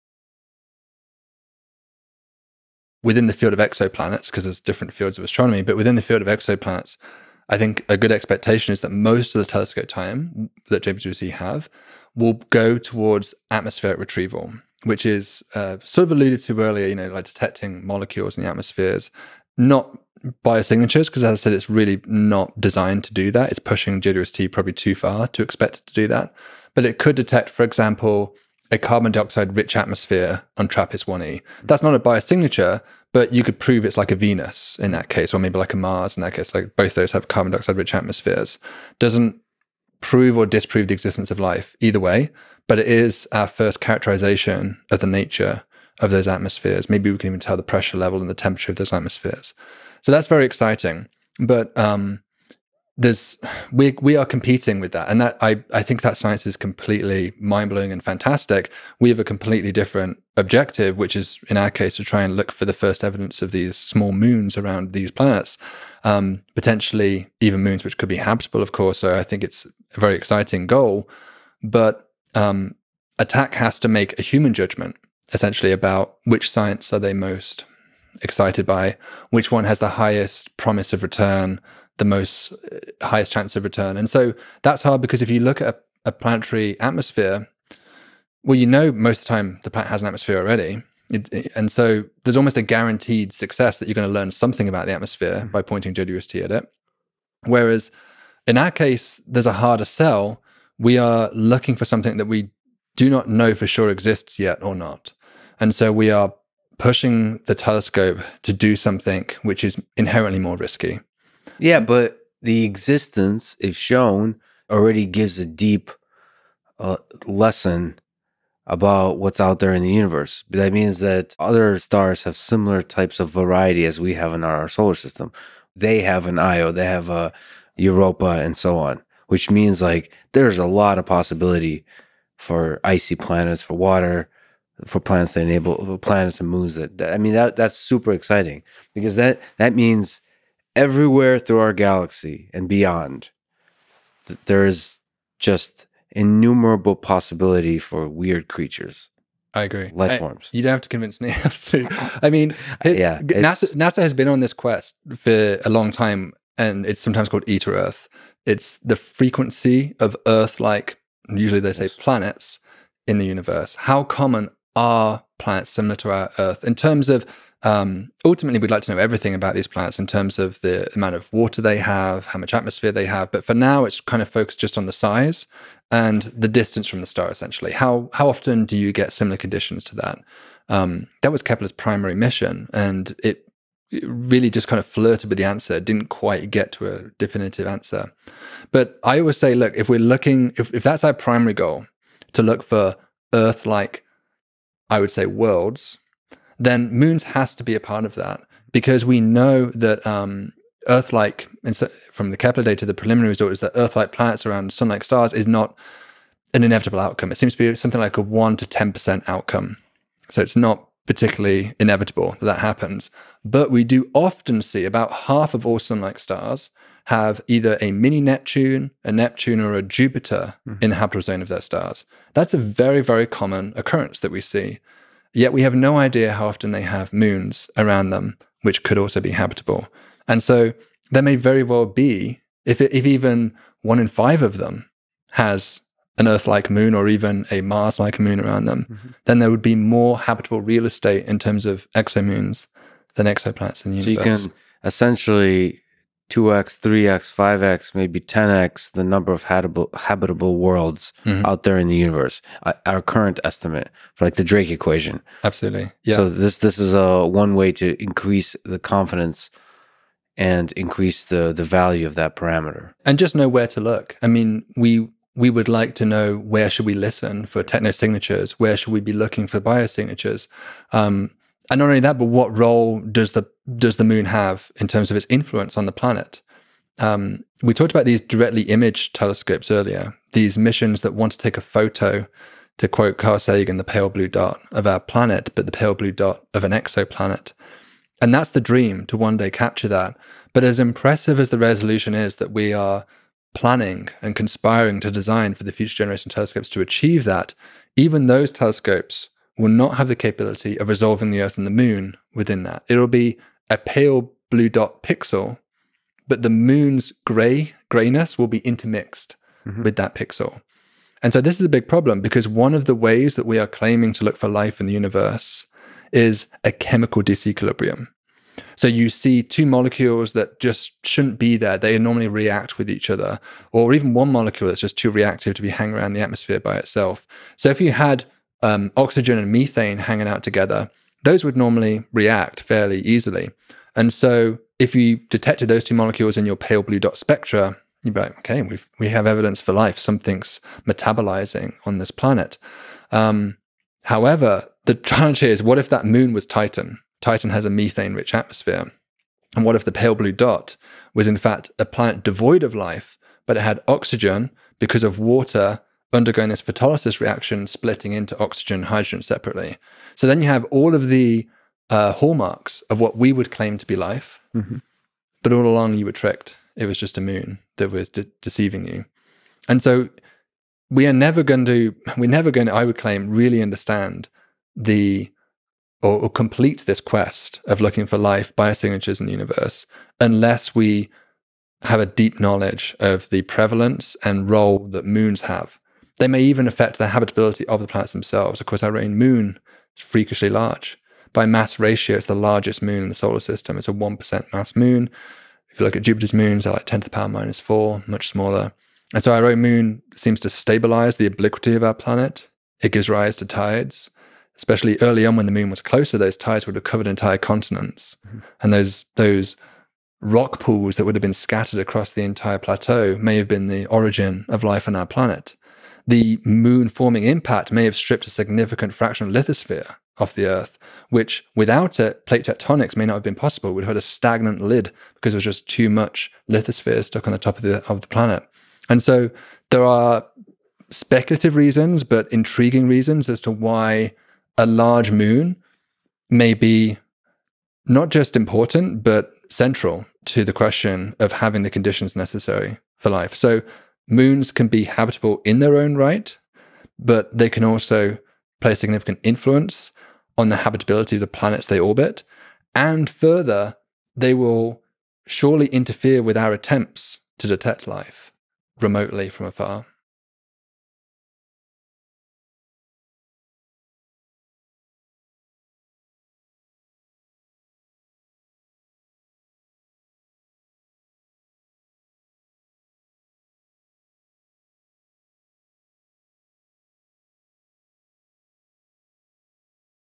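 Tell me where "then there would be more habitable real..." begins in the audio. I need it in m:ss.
3:59.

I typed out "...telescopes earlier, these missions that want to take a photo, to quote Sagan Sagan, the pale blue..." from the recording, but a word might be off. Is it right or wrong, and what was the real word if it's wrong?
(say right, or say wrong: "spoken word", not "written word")
wrong: "Carl", not "Sagan".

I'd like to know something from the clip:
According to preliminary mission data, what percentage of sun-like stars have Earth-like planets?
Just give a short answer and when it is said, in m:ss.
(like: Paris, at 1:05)
1 to 10 percent, at 3:28.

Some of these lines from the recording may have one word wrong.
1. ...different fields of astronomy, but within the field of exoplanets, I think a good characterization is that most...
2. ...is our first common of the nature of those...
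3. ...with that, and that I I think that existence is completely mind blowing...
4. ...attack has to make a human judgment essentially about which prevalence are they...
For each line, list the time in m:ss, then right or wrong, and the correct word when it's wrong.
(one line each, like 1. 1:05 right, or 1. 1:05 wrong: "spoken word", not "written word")
1. 0:04 wrong: "expectation", not "characterization"
2. 0:42 wrong: "characterization", not "common"
3. 0:54 wrong: "science", not "existence"
4. 1:13 wrong: "science", not "prevalence".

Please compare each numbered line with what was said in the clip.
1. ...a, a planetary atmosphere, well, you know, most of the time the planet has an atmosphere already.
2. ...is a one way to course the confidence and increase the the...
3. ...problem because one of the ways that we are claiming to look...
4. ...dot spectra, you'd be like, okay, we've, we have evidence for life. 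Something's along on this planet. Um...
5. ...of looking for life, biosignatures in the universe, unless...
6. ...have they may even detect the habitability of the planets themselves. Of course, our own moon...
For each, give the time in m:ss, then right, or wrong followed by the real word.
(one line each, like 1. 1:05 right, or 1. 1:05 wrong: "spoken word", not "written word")
1. 1:26 right
2. 4:16 wrong: "increase", not "course"
3. 5:11 right
4. 5:36 wrong: "metabolizing", not "along"
5. 6:17 right
6. 6:25 wrong: "affect", not "detect".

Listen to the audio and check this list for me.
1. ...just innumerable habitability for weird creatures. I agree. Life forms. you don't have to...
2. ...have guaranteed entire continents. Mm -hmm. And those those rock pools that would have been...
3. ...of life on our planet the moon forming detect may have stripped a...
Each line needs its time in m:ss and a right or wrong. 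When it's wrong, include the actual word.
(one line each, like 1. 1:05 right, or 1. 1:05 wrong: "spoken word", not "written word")
1. 2:25 wrong: "possibility", not "habitability"
2. 6:46 wrong: "covered", not "guaranteed"
3. 6:54 wrong: "impact", not "detect".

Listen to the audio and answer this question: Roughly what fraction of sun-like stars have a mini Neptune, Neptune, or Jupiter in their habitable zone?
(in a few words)
half.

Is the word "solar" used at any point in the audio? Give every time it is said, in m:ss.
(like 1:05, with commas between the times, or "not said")
2:04, 6:33.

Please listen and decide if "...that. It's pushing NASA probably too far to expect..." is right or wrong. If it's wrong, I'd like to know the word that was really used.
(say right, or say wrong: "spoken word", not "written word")
wrong: "JWST", not "NASA".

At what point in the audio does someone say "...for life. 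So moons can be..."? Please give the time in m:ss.
7:22.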